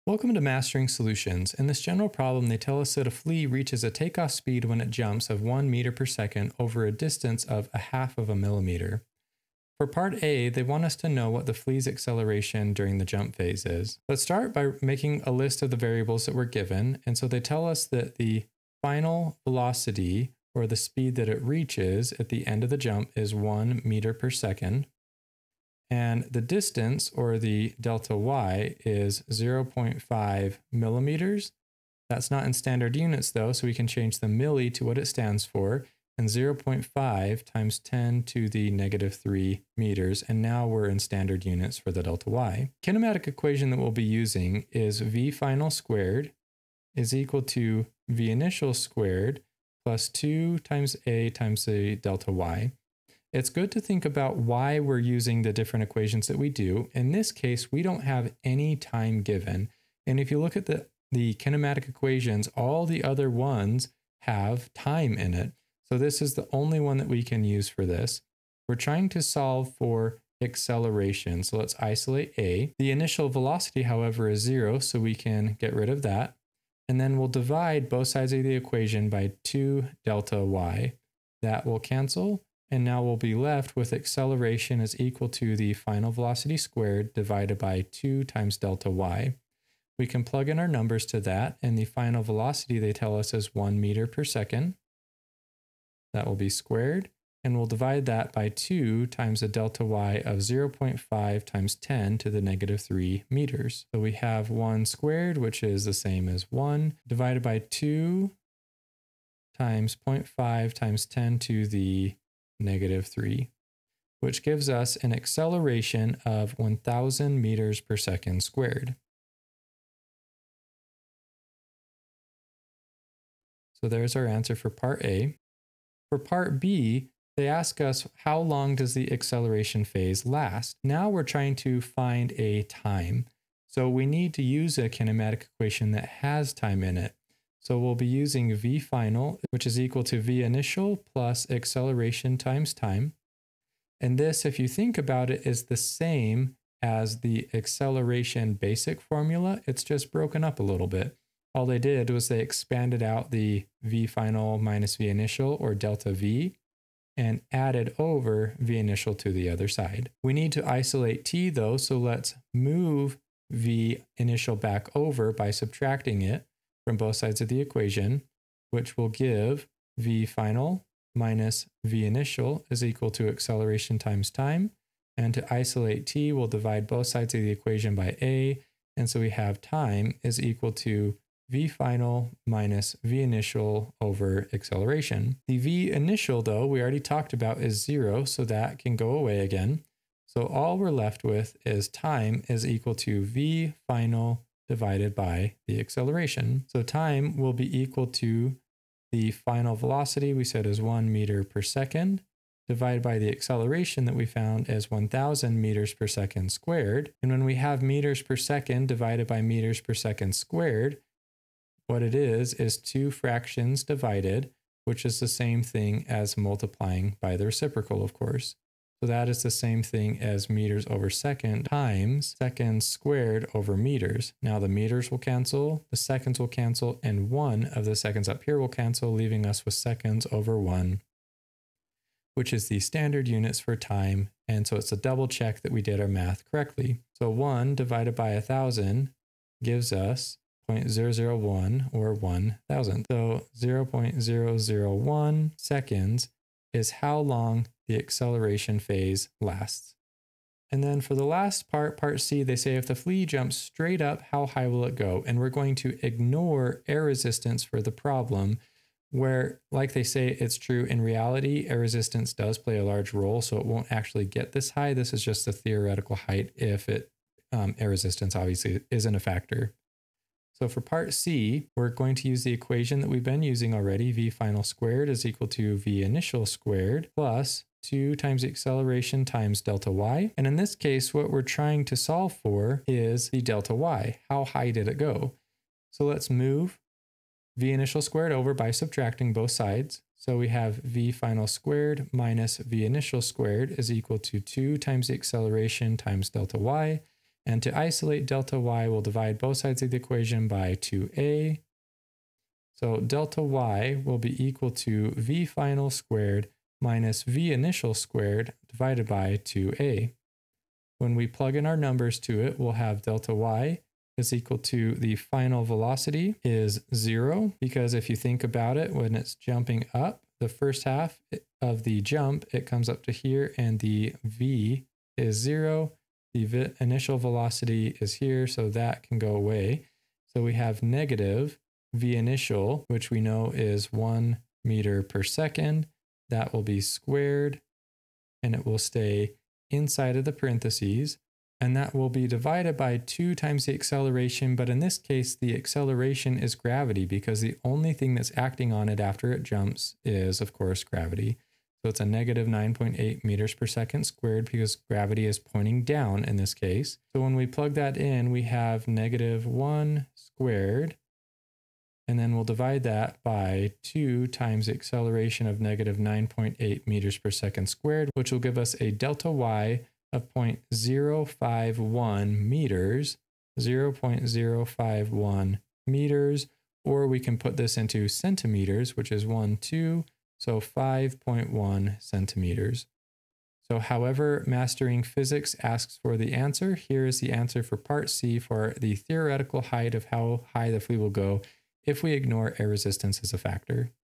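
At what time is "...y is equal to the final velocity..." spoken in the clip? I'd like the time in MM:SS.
05:13.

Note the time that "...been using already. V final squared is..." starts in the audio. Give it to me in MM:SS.
04:33.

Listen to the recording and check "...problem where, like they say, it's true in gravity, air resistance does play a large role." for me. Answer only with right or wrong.
wrong.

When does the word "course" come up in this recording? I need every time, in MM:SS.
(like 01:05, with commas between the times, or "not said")
03:38, 05:50.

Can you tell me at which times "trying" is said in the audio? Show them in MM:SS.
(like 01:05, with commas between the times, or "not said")
01:08, 02:11, 04:41.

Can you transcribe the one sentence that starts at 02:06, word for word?
For part B, they ask us how long does the acceleration phase last?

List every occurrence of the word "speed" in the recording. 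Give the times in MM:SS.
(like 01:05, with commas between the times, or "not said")
00:04, 00:20.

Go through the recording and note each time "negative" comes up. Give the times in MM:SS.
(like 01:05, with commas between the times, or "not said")
00:38, 01:42, 01:52, 05:30, 05:52, 05:58, 06:05.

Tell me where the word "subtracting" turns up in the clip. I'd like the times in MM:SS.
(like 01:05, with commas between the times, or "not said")
02:45, 04:48.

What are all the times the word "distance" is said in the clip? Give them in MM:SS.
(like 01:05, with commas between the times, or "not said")
00:06, 00:26.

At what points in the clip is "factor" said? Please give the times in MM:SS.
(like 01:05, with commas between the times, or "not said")
04:29, 06:33.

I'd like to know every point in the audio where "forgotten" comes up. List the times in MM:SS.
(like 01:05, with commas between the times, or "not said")
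not said.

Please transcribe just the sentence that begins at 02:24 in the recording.
And this, if you think about it, is the same as the acceleration basic formula.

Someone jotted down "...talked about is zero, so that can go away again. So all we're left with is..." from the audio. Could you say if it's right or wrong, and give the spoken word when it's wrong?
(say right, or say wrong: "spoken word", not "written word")
right.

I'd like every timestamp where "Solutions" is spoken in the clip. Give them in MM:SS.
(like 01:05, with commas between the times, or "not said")
00:00.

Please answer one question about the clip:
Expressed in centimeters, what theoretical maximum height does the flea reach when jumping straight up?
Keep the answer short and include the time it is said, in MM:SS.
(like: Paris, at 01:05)
5.1 centimeters, at 06:20.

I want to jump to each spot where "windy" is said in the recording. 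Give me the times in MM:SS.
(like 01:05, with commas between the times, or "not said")
not said.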